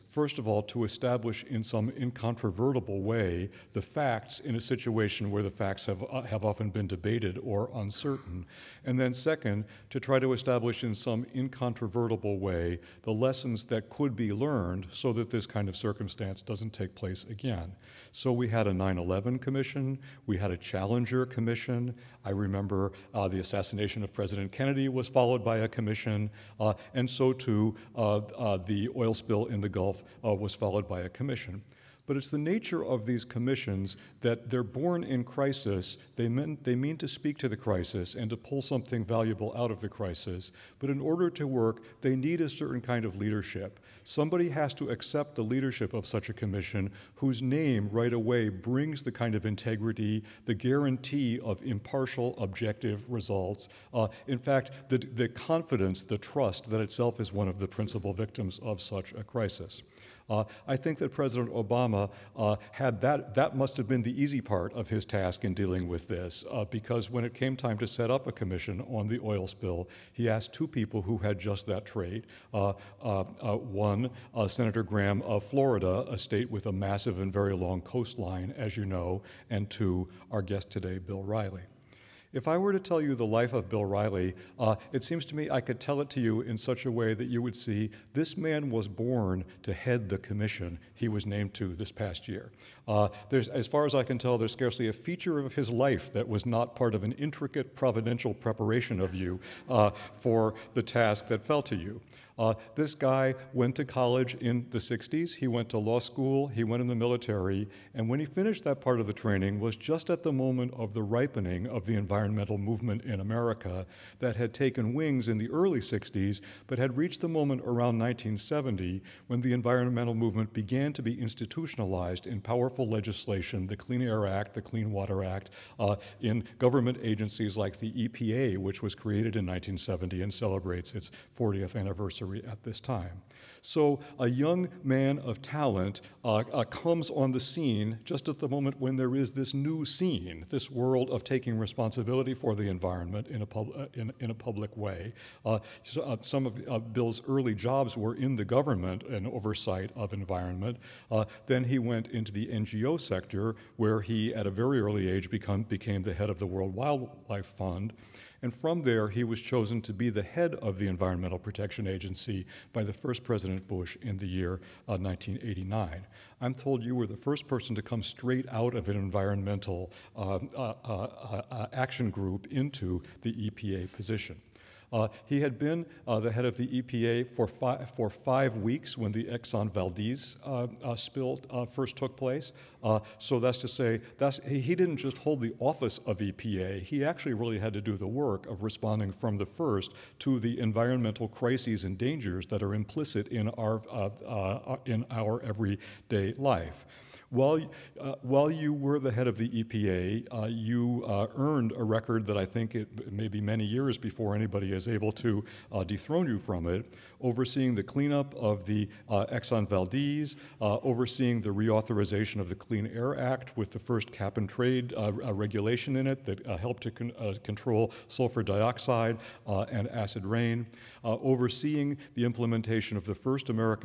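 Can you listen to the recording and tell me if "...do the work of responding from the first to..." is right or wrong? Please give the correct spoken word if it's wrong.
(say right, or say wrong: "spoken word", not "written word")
right.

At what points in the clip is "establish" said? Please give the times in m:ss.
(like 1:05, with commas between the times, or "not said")
0:00, 0:10.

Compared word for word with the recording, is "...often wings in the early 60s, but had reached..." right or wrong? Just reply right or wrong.
wrong.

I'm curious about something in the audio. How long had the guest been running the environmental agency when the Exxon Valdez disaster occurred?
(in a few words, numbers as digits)
5 weeks.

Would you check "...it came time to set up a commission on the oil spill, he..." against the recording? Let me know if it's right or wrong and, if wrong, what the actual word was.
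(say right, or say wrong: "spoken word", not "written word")
right.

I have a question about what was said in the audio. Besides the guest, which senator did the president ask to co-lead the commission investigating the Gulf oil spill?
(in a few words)
Senator Graham.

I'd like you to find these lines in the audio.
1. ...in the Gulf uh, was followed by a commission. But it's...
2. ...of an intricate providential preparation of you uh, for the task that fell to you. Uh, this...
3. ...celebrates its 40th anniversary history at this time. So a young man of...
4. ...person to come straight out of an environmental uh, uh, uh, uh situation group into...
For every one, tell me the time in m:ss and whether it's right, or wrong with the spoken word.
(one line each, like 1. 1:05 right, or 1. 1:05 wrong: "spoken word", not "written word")
1. 0:29 right
2. 1:36 right
3. 2:10 right
4. 2:47 wrong: "action", not "situation".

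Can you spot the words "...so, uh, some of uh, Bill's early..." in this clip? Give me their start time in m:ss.
2:25.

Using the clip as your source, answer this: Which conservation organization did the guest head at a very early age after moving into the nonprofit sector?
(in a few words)
World Wildlife Fund.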